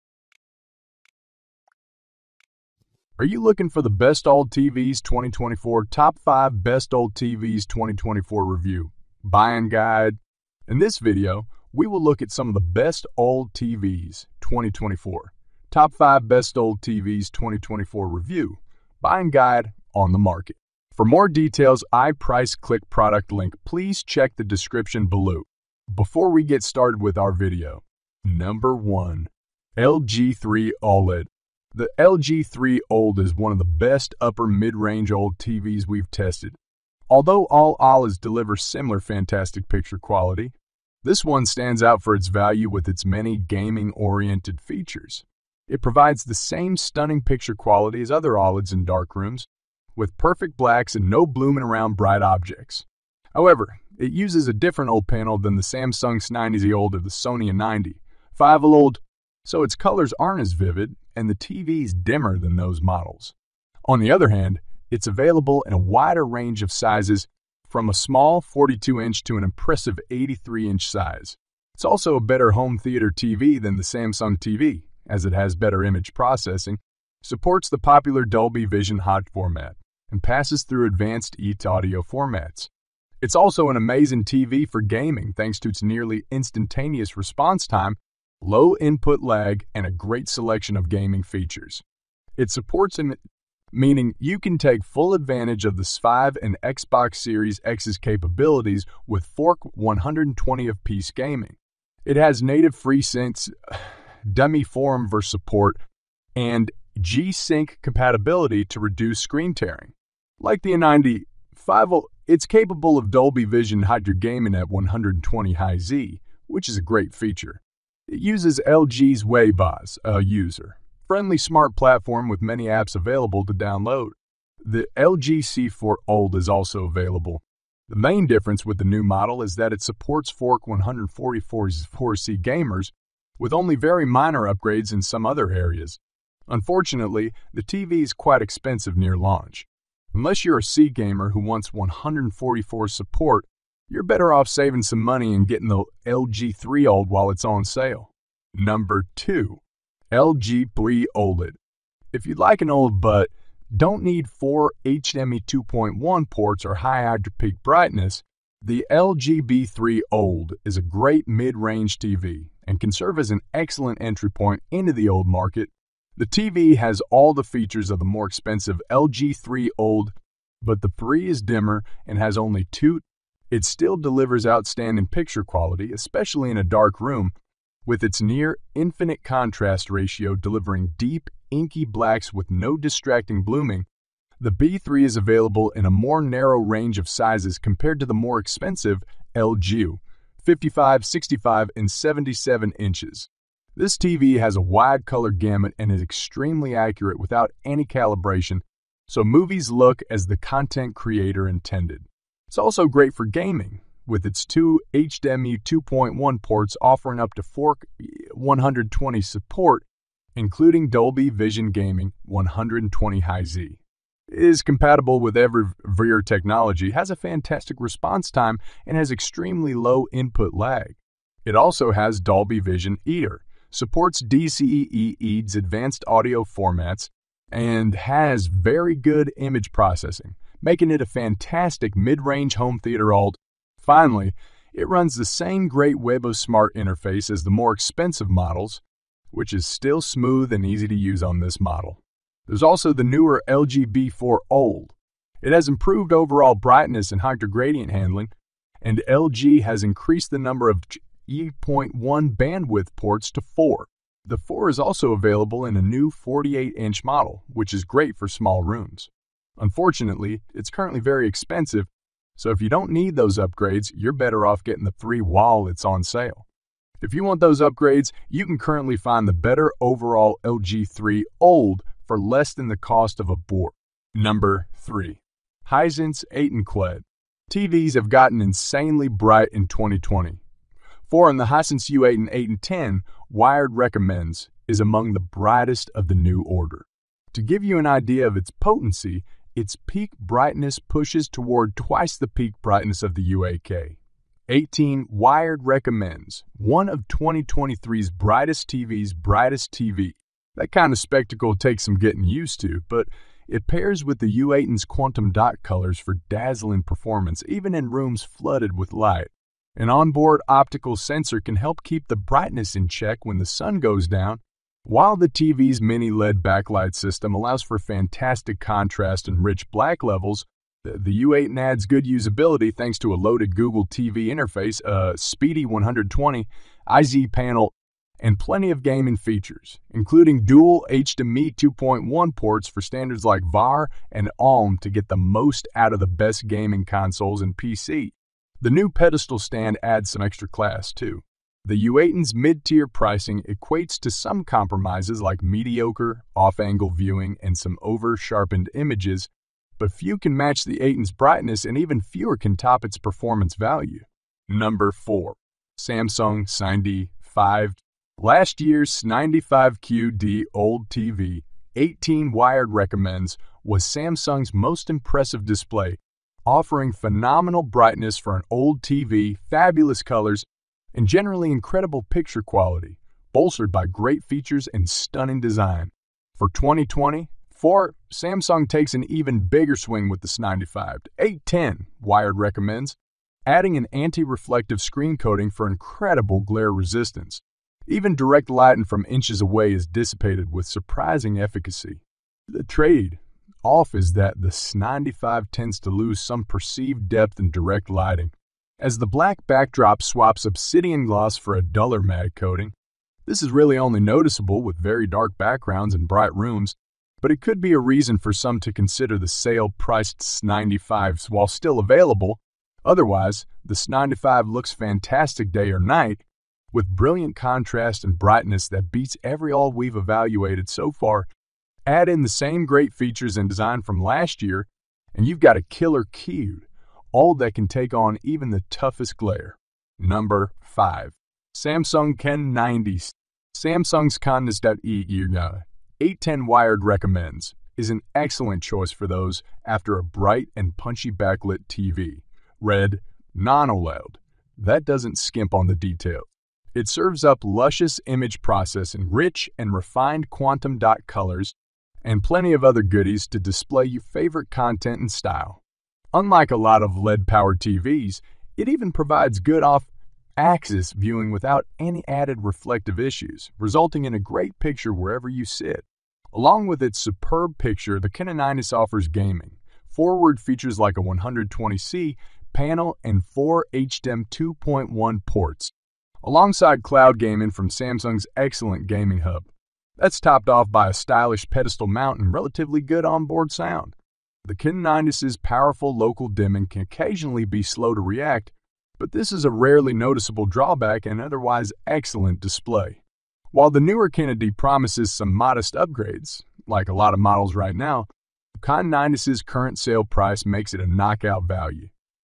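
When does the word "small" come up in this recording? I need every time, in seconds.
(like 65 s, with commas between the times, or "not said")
67 s, 258 s.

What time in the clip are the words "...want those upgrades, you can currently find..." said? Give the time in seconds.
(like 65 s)
267 s.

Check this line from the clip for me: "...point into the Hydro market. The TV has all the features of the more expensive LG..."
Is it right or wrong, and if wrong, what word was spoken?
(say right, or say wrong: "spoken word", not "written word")
wrong: "OLED", not "Hydro".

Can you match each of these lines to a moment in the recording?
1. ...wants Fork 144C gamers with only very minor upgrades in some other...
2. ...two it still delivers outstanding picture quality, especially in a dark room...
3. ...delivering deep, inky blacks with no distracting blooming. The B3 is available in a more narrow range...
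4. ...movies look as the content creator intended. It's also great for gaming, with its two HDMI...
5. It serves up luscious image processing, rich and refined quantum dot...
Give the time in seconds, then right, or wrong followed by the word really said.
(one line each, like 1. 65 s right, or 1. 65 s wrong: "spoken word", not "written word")
1. 129 s wrong: "supports", not "wants"
2. 172 s right
3. 180 s right
4. 199 s right
5. 446 s right.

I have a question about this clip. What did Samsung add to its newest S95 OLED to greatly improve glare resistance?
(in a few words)
anti-reflective screen coating.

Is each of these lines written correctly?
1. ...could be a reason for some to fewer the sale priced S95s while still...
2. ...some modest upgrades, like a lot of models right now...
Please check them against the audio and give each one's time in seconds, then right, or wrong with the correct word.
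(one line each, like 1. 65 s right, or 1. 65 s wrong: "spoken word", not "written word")
1. 407 s wrong: "consider", not "fewer"
2. 495 s right.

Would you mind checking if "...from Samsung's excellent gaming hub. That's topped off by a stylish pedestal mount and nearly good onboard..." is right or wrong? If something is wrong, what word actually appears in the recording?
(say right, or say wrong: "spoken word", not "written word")
wrong: "relatively", not "nearly".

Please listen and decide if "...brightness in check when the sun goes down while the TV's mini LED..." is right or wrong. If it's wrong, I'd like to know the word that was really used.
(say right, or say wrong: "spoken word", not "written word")
right.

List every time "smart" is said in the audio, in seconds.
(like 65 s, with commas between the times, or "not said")
121 s, 236 s.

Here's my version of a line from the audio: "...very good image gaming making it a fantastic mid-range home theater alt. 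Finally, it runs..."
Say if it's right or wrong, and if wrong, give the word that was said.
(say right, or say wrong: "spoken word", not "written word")
wrong: "processing", not "gaming".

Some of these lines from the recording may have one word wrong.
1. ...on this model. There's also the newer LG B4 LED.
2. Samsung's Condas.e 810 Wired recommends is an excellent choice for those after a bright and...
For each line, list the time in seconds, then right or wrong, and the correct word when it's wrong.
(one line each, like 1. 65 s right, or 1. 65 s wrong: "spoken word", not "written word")
1. 241 s wrong: "OLED", not "LED"
2. 433 s right.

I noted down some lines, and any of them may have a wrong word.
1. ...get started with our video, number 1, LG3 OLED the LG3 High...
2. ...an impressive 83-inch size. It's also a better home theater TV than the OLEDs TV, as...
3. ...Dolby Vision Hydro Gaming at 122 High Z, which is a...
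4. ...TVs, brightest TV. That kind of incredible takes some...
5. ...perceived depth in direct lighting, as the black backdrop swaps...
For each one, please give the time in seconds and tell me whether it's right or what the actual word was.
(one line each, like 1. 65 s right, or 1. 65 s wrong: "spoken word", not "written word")
1. 26 s wrong: "OLED", not "High"
2. 69 s wrong: "Samsung", not "OLEDs"
3. 113 s wrong: "120", not "122"
4. 298 s wrong: "spectacle", not "incredible"
5. 396 s right.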